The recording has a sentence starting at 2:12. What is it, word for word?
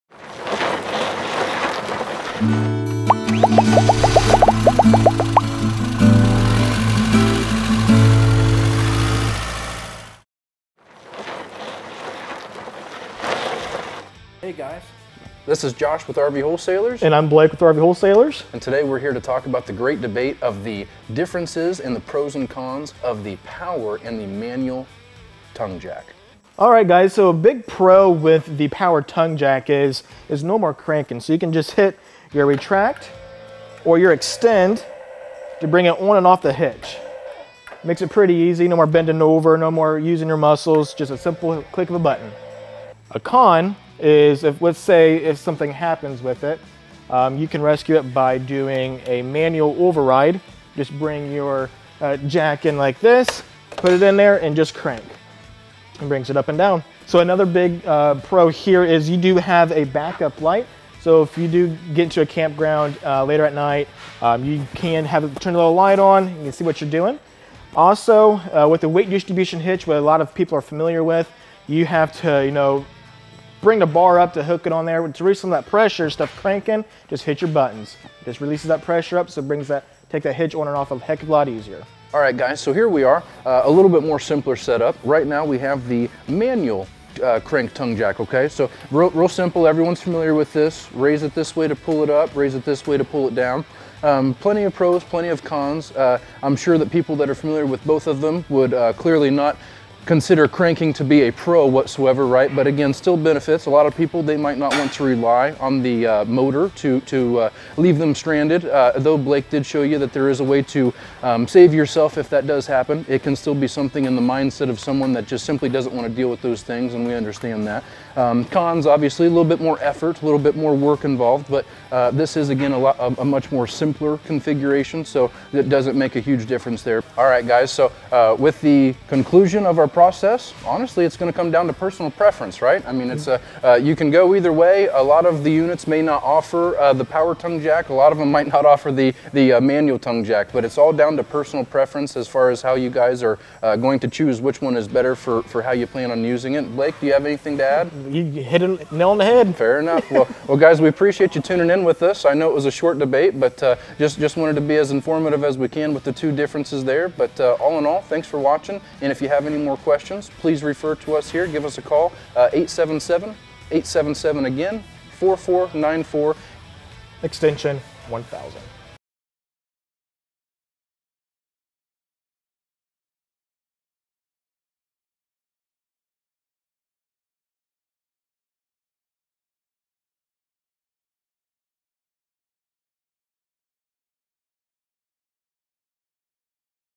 I mean, it's a, uh, you can go either way.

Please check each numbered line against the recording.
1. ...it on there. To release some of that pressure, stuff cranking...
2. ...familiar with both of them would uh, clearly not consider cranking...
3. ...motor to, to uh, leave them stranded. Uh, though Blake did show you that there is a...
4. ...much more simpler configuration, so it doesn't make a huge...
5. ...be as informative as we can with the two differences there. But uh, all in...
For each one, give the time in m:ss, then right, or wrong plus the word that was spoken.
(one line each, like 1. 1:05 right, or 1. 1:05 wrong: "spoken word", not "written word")
1. 1:14 right
2. 1:37 right
3. 1:46 right
4. 2:03 right
5. 2:34 right.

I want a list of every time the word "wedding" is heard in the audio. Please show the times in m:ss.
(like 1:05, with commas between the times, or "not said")
not said.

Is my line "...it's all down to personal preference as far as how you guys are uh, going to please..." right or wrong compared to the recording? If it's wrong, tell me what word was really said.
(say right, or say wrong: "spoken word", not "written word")
wrong: "choose", not "please".